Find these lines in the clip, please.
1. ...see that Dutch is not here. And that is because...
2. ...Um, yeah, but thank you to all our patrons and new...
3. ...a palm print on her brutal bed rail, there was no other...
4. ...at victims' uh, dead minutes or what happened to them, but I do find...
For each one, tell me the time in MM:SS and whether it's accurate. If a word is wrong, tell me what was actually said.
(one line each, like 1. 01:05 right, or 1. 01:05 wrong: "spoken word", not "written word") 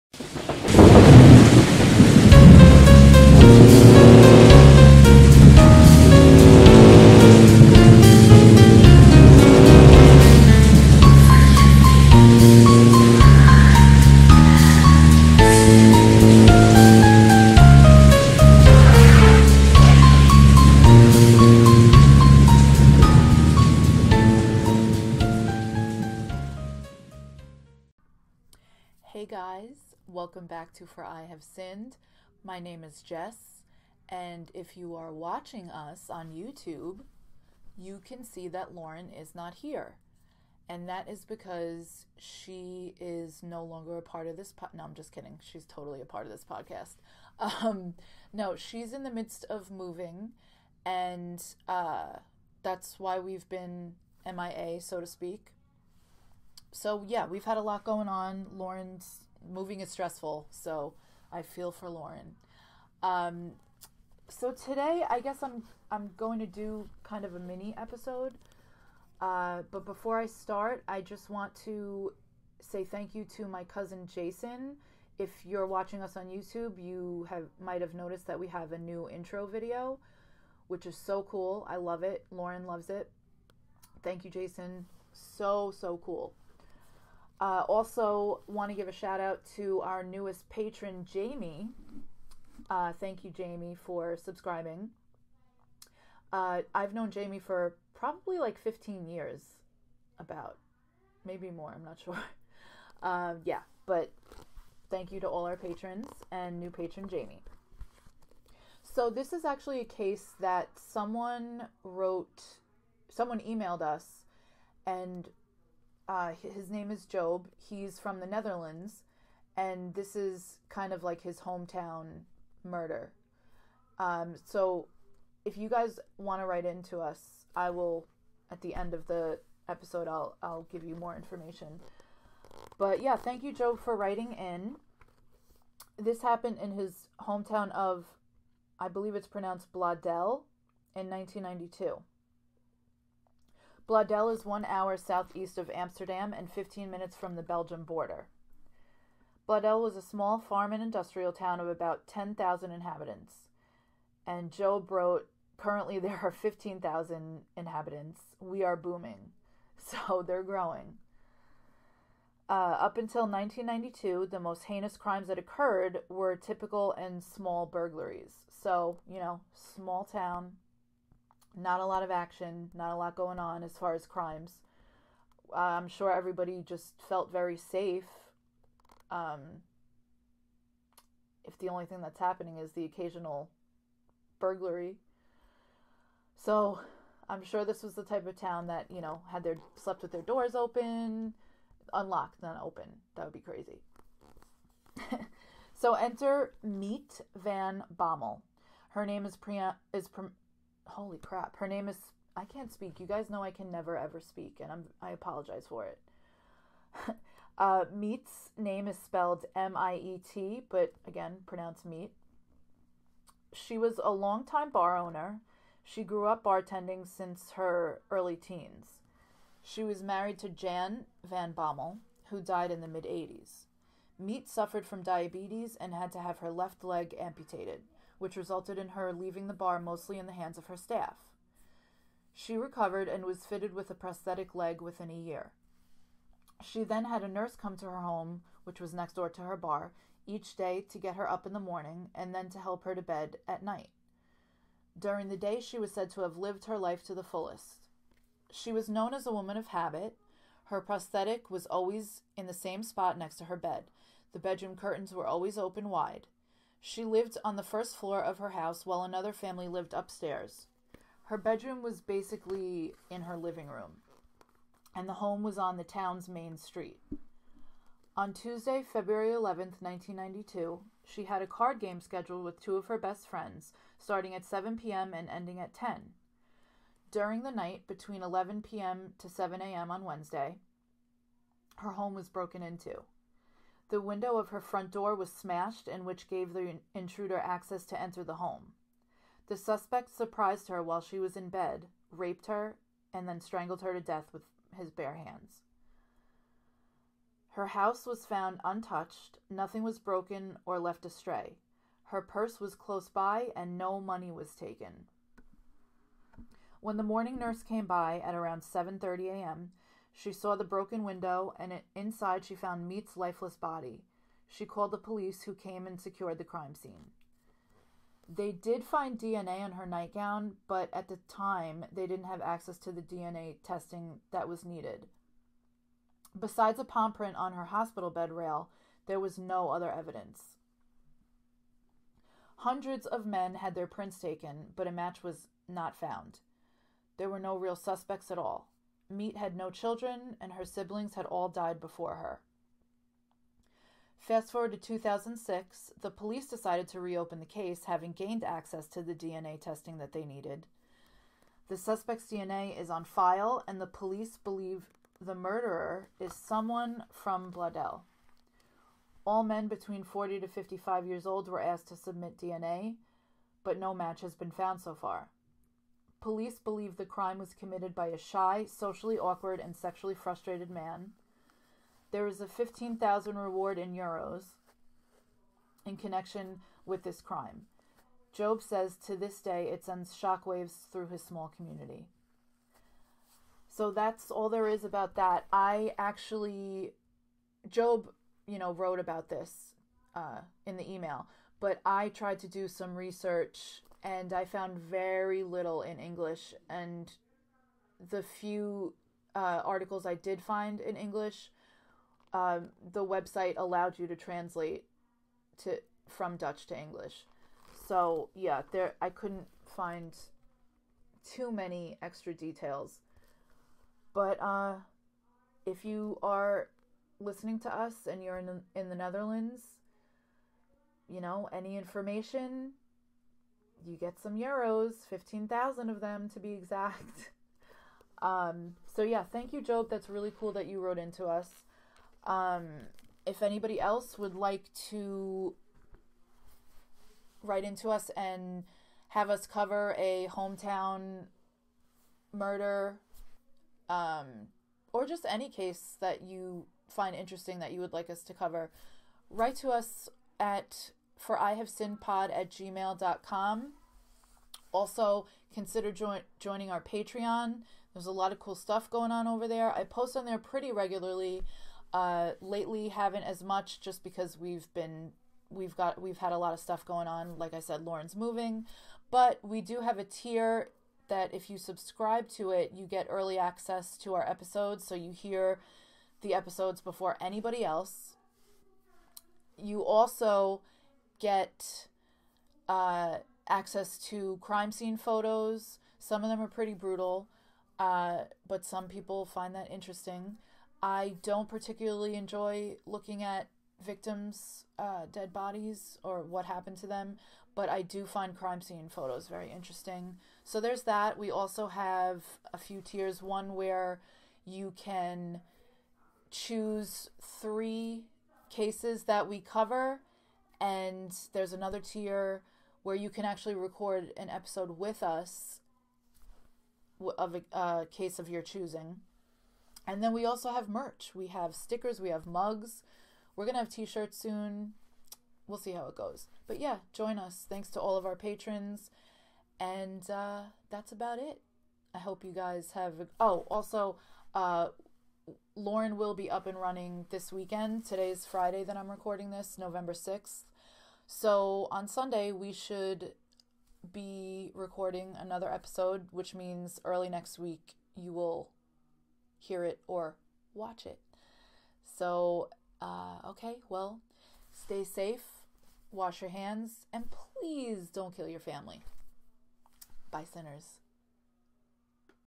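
1. 00:38 wrong: "Lauren", not "Dutch"
2. 01:43 right
3. 05:26 wrong: "hospital", not "brutal"
4. 08:13 wrong: "bodies", not "minutes".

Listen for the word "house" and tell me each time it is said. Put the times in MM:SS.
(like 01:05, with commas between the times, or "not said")
04:18, 04:57.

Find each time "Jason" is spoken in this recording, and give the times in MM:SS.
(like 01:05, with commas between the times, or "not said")
01:14, 01:24.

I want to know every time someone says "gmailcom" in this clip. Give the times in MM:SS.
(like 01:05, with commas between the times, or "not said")
07:32.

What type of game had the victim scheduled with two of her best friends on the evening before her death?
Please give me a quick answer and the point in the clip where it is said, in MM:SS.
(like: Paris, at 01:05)
card game, at 04:31.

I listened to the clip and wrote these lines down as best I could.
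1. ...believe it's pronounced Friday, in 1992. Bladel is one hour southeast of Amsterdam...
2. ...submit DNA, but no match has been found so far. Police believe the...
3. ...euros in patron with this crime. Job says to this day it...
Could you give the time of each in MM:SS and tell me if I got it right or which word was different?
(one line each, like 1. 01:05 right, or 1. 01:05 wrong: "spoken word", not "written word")
1. 02:18 wrong: "Bladel", not "Friday"
2. 06:01 right
3. 06:13 wrong: "connection", not "patron".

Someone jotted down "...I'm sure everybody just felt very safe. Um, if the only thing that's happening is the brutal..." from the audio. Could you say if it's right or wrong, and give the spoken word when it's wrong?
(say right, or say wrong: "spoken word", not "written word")
wrong: "occasional", not "brutal".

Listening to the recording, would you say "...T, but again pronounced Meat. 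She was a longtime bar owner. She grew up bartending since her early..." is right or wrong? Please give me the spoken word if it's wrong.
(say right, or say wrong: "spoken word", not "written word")
right.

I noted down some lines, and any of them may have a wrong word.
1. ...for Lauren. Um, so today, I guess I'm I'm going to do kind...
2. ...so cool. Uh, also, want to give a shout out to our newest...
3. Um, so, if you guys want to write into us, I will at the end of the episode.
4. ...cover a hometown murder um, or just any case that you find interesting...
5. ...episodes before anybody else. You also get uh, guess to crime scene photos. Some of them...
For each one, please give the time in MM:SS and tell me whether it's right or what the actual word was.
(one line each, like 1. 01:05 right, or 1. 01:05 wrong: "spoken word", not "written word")
1. 01:01 right
2. 01:25 right
3. 02:03 right
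4. 07:19 right
5. 07:56 wrong: "access", not "guess".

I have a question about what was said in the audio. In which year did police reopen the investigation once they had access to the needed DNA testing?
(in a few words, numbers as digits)
2006.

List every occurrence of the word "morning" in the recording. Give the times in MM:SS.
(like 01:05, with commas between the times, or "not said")
04:01, 05:07.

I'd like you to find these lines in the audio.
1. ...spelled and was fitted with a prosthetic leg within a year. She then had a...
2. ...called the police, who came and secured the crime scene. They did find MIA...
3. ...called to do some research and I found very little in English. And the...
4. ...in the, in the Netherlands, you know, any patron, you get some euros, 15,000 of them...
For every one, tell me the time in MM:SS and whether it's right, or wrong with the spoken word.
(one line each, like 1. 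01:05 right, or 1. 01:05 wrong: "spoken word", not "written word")
1. 03:52 wrong: "recovered", not "spelled"
2. 05:14 wrong: "DNA", not "MIA"
3. 06:32 wrong: "tried", not "called"
4. 06:58 wrong: "information", not "patron".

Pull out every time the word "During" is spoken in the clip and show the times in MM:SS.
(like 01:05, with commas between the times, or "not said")
04:04, 04:37.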